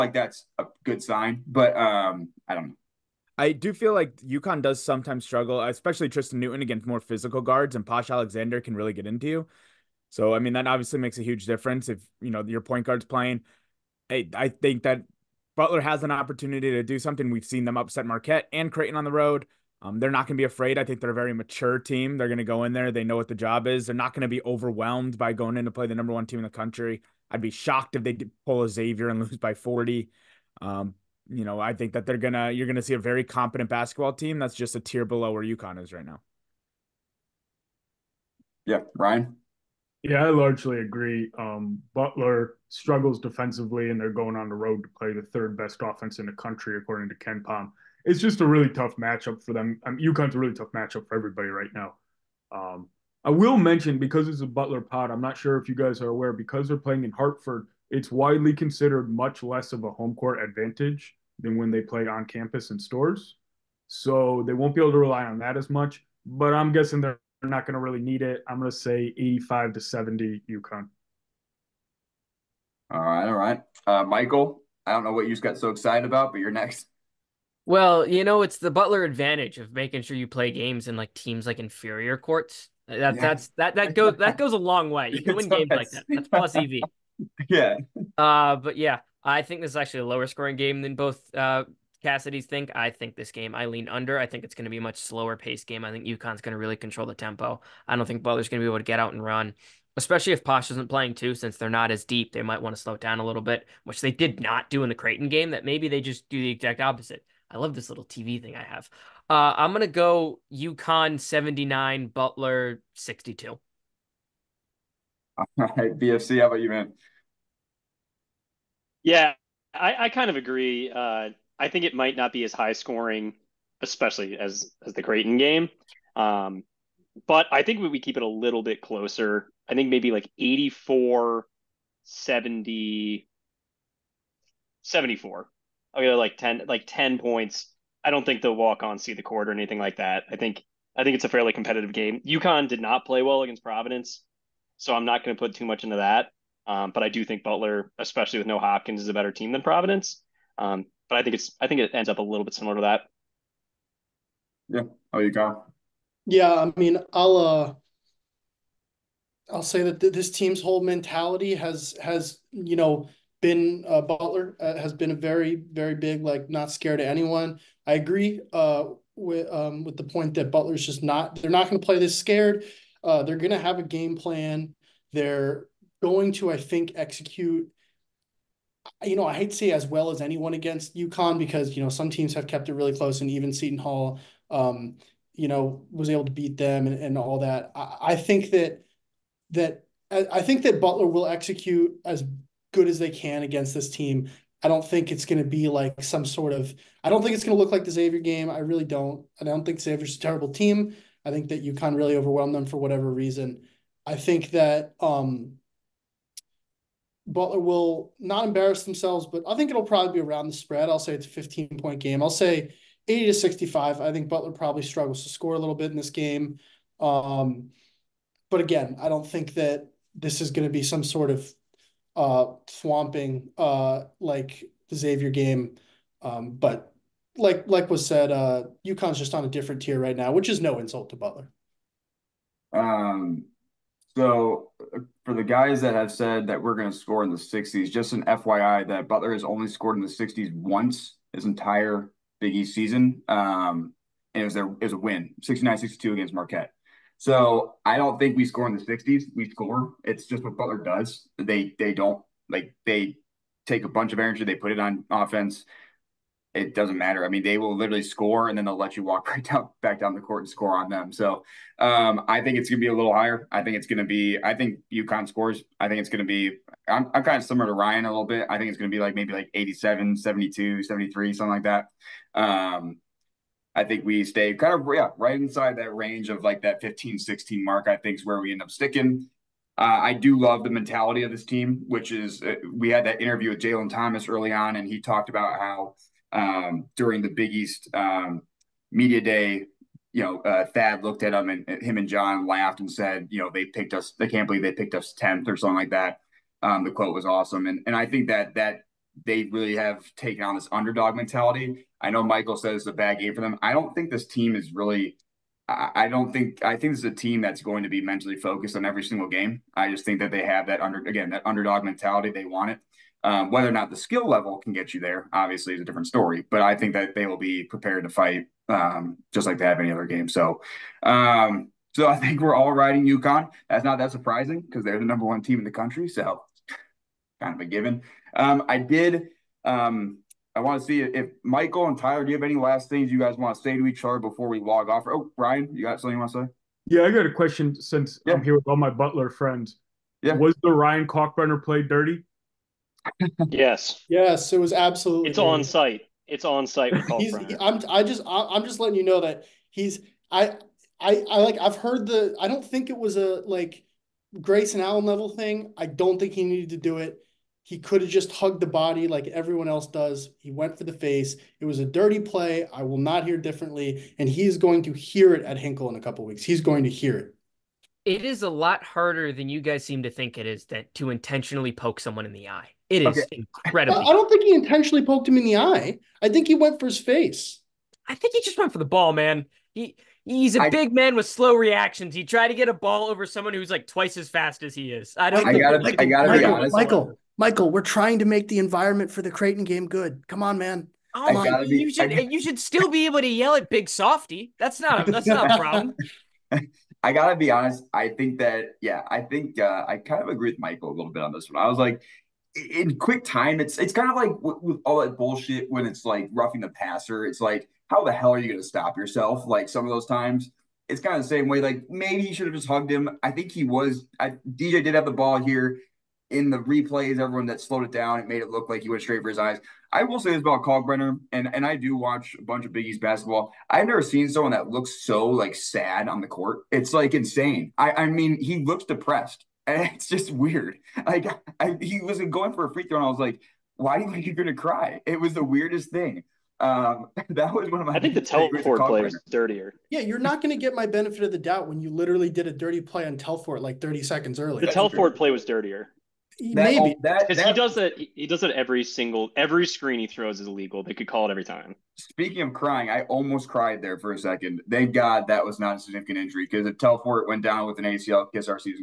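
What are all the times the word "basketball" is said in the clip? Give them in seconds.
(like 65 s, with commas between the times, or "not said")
33 s, 422 s.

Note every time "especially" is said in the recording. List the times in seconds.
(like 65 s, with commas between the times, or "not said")
5 s, 99 s, 123 s, 147 s.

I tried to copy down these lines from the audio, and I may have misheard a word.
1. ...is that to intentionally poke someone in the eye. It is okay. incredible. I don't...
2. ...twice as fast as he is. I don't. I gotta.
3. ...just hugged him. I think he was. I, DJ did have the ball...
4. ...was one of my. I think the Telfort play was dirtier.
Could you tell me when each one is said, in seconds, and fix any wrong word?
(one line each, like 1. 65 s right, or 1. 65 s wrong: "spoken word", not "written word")
1. 370 s right
2. 383 s right
3. 412 s right
4. 437 s right.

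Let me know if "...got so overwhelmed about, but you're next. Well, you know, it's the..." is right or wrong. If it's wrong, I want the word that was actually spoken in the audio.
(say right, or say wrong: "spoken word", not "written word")
wrong: "excited", not "overwhelmed".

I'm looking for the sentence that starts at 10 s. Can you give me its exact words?
So I mean that obviously makes a huge difference if you know your point guard's playing.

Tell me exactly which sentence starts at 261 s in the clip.
So um, I think it's gonna be a little higher.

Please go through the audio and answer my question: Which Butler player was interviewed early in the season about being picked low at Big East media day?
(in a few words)
Jalen Thomas.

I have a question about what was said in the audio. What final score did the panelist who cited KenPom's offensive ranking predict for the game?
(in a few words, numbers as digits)
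85 to 70.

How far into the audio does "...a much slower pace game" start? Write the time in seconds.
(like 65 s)
94 s.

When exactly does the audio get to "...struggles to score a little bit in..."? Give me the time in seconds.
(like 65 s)
214 s.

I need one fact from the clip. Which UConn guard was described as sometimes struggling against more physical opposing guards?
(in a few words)
Tristen Newton.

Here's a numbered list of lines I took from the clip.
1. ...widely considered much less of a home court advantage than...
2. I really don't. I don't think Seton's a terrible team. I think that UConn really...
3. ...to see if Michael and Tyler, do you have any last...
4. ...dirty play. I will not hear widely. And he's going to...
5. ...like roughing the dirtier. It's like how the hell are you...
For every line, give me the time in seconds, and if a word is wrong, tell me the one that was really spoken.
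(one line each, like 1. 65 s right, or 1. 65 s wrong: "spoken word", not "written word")
1. 58 s right
2. 198 s wrong: "Xavier", not "Seton"
3. 330 s right
4. 361 s wrong: "differently", not "widely"
5. 406 s wrong: "passer", not "dirtier".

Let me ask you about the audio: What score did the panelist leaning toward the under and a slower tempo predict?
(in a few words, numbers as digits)
79-62.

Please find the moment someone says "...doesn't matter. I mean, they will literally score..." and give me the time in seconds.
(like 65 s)
256 s.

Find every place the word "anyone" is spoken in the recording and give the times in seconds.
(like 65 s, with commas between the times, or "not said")
167 s, 180 s.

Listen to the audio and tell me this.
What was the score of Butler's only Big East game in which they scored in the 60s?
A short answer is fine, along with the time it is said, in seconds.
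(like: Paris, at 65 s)
69-62, at 245 s.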